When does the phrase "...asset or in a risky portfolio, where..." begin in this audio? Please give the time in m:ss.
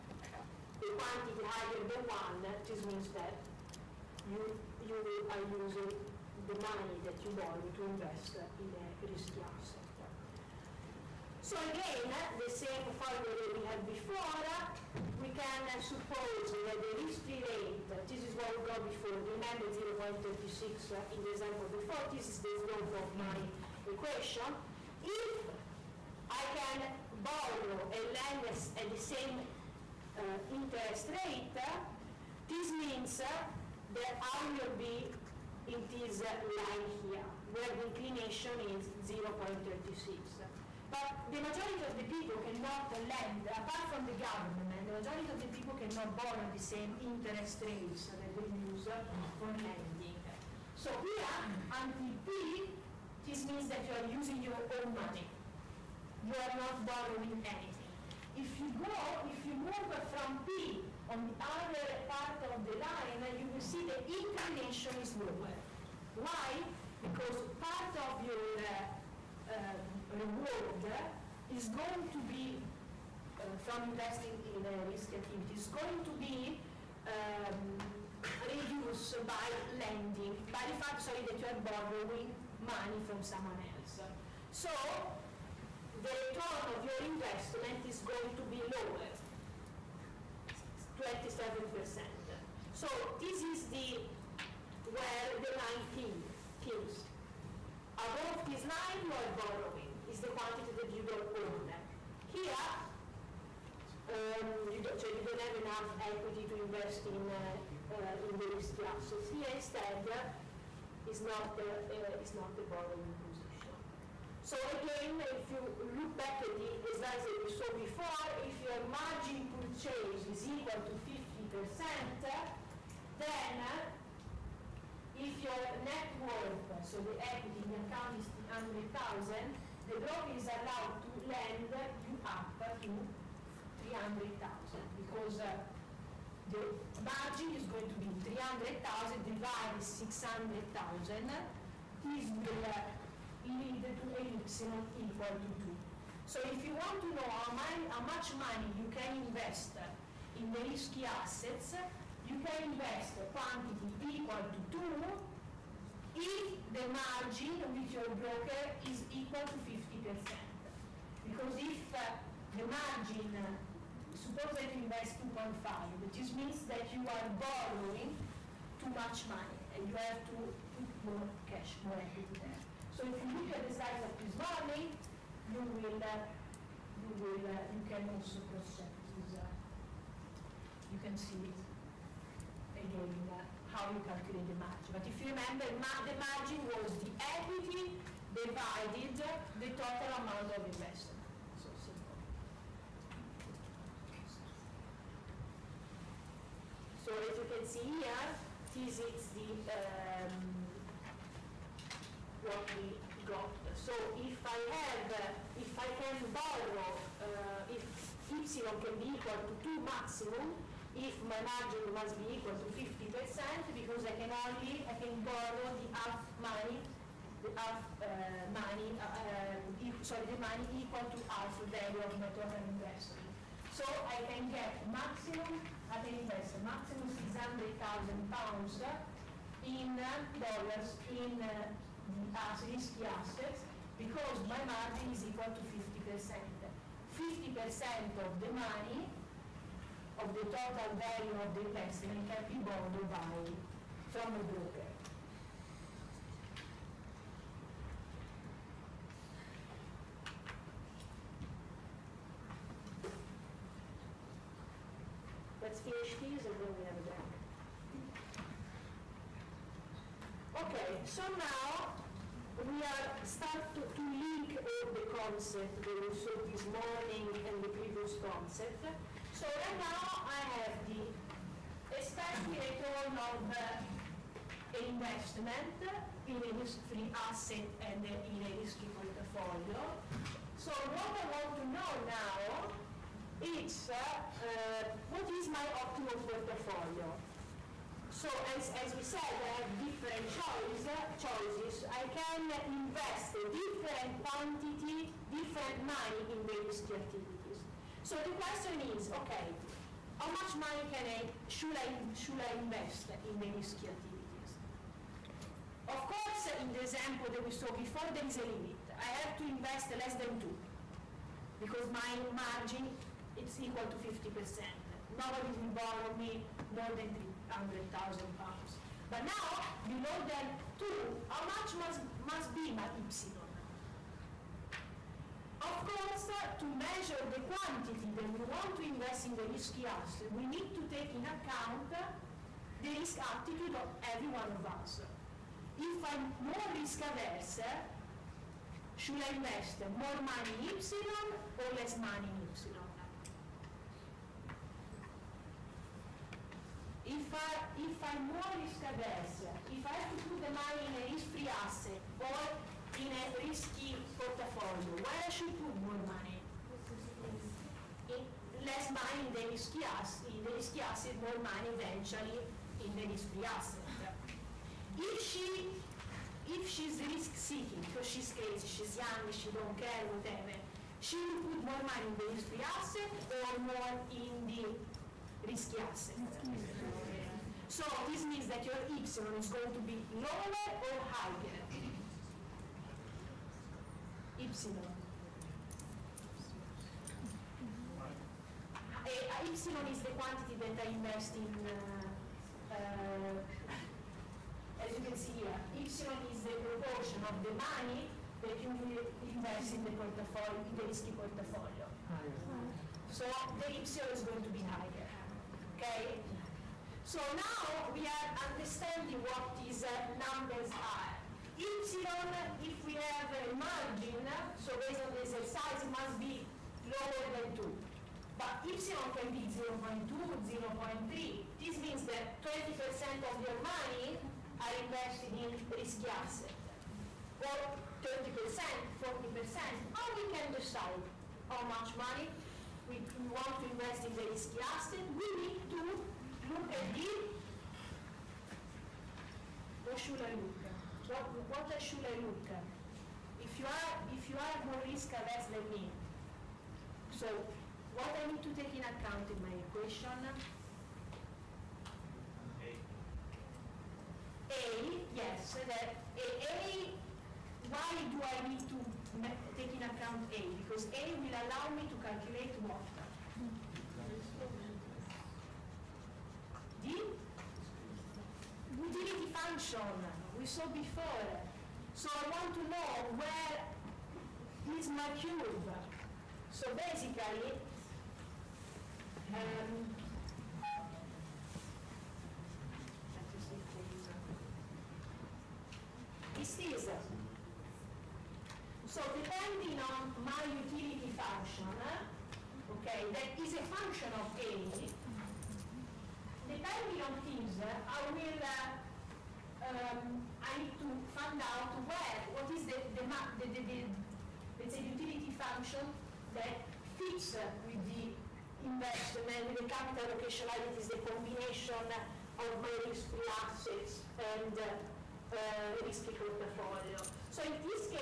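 5:51.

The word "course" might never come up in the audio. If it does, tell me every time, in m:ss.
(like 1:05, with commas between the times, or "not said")
5:06, 5:25.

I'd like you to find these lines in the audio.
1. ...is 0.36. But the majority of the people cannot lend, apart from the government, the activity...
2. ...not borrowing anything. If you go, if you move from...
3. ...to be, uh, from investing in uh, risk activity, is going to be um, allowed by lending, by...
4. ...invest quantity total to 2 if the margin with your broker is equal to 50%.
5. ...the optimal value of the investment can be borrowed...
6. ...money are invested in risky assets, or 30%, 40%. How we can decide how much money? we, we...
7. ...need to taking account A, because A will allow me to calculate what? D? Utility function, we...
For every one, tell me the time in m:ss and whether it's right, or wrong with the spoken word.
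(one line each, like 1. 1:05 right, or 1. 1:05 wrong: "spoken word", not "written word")
1. 0:38 wrong: "majority", not "activity"
2. 0:56 right
3. 1:12 wrong: "reduced", not "allowed"
4. 2:32 wrong: "equal", not "total"
5. 4:00 wrong: "total", not "optimal"
6. 7:03 right
7. 7:38 right.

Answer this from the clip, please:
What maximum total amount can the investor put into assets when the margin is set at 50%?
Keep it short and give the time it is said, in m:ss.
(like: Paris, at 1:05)
600,000 pounds, at 3:47.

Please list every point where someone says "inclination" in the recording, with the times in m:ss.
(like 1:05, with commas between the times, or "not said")
0:37, 1:04.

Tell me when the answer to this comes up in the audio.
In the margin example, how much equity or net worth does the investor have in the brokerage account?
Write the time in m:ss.
2:08.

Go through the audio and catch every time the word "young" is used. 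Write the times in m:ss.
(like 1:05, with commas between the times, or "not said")
6:08.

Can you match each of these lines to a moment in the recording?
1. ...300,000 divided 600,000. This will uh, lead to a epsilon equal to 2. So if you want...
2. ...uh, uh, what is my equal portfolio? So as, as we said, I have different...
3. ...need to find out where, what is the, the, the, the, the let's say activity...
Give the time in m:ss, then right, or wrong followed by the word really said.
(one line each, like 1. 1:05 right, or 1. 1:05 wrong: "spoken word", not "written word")
1. 2:18 right
2. 4:43 wrong: "optimal", not "equal"
3. 8:20 wrong: "utility", not "activity".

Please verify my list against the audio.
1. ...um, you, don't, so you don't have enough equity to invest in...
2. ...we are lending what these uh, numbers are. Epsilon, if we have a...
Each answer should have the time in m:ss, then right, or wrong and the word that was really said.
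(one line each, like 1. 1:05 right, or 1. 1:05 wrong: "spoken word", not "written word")
1. 1:44 right
2. 6:47 wrong: "understanding", not "lending".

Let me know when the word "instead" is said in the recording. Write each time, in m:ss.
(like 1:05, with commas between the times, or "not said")
1:49.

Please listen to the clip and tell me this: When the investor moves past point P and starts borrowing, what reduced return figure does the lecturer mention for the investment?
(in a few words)
27%.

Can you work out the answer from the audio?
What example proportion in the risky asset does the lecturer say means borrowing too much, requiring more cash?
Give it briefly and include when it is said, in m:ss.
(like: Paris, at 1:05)
2.5, at 2:45.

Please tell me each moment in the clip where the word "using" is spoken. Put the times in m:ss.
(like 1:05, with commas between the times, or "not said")
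0:05, 0:54.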